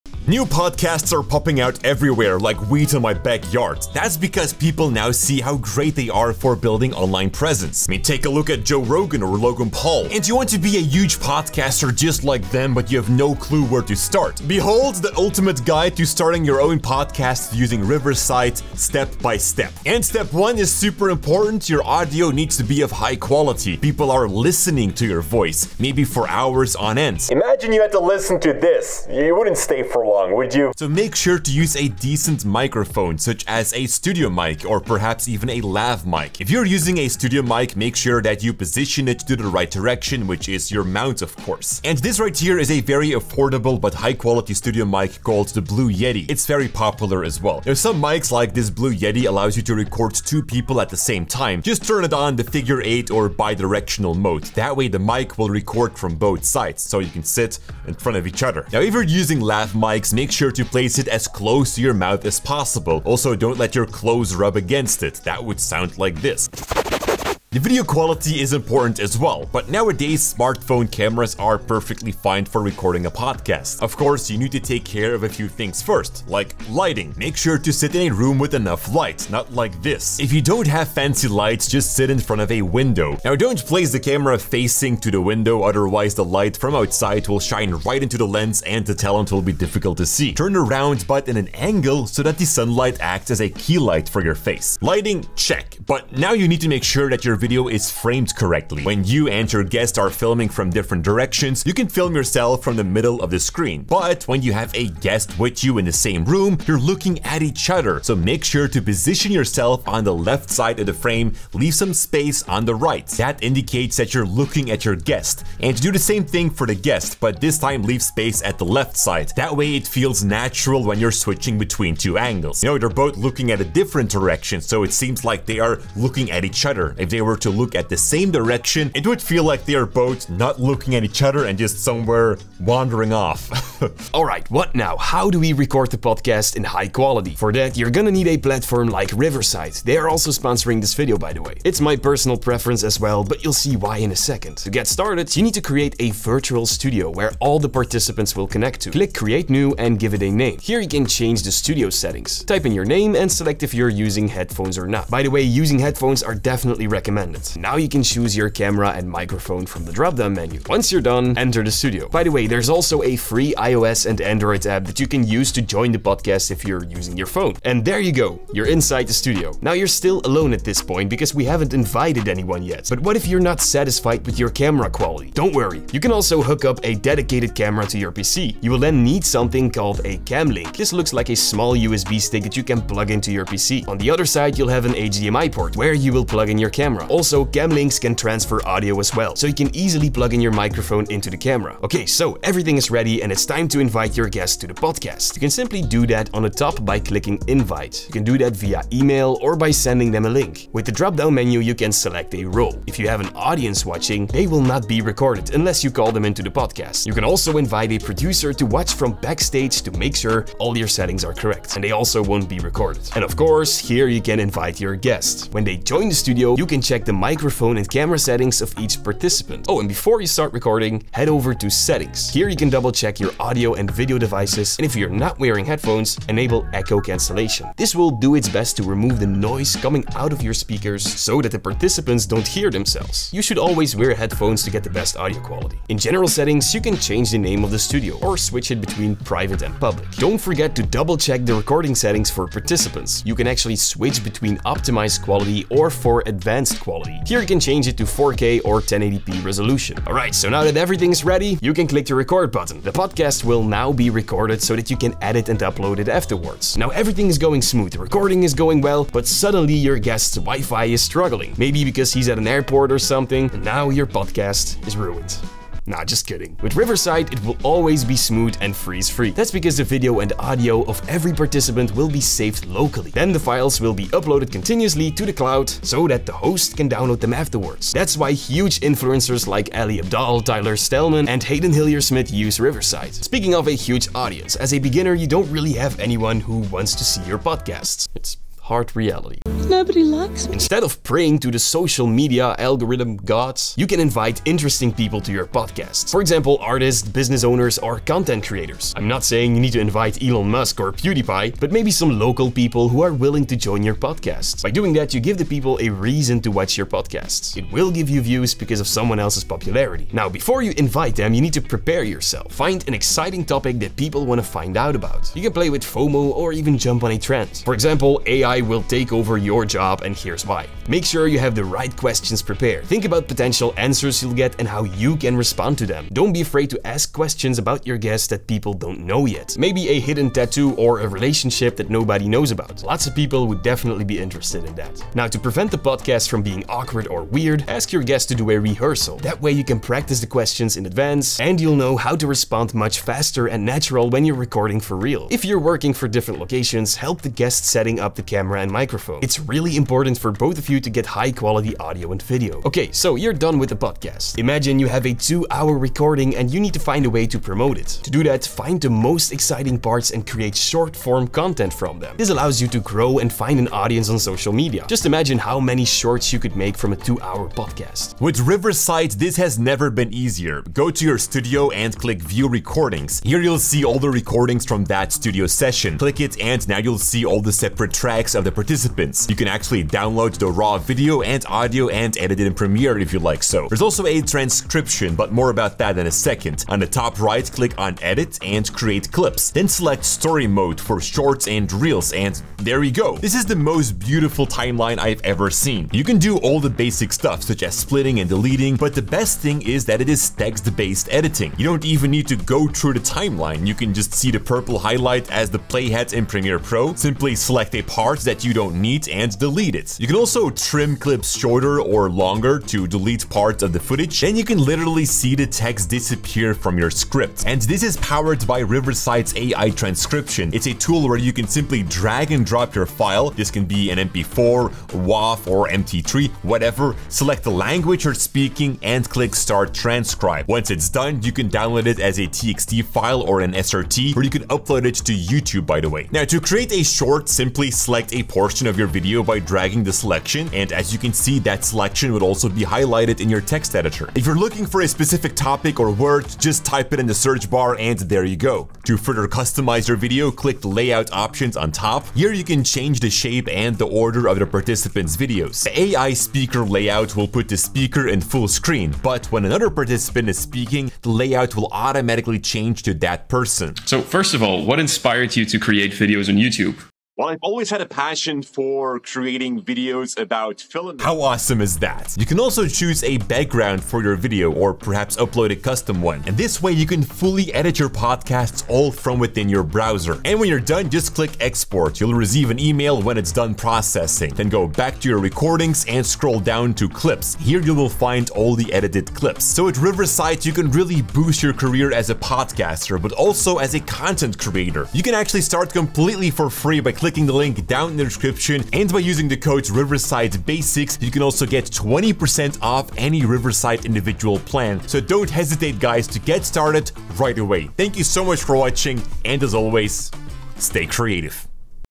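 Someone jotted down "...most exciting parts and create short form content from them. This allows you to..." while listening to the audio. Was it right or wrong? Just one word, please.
right.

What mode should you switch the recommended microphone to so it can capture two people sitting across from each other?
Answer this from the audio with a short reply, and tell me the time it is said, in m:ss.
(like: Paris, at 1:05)
figure eight, at 0:52.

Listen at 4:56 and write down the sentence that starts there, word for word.
For example, artists, business owners, or content creators.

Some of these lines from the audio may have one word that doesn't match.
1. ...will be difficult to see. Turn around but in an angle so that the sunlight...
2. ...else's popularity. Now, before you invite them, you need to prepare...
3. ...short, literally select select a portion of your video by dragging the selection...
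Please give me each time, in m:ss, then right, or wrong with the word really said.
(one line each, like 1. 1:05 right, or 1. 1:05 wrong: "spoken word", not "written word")
1. 1:29 right
2. 5:09 right
3. 7:16 wrong: "simply", not "literally".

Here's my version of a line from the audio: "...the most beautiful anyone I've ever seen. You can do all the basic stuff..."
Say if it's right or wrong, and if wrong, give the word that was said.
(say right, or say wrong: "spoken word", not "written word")
wrong: "timeline", not "anyone".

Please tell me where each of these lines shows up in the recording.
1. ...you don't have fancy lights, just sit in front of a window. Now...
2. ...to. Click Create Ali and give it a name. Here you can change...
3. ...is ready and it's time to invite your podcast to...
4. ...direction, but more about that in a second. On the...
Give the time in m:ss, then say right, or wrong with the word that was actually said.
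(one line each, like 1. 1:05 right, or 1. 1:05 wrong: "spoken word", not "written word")
1. 1:20 right
2. 2:28 wrong: "New", not "Ali"
3. 3:12 wrong: "guest", not "podcast"
4. 6:24 wrong: "transcription", not "direction".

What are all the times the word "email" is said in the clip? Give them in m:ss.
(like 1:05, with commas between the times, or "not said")
3:18, 8:02.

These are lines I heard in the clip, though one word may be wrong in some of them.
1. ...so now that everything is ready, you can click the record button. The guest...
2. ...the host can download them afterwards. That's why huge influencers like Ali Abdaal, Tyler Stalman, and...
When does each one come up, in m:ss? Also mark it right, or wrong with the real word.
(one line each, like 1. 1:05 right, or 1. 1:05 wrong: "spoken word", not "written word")
1. 4:10 wrong: "podcast", not "guest"
2. 4:36 right.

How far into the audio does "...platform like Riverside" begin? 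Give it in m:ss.
2:18.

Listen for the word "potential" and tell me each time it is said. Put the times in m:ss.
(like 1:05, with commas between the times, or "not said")
5:23.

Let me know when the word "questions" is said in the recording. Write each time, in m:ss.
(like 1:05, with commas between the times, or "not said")
5:21, 5:27, 5:40.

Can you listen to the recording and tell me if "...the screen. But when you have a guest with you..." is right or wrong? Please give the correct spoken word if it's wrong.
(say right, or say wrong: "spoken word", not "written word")
right.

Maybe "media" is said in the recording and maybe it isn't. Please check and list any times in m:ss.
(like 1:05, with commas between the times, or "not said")
4:52, 6:04.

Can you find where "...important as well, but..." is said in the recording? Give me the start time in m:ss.
1:08.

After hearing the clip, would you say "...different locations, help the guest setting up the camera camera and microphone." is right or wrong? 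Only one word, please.
right.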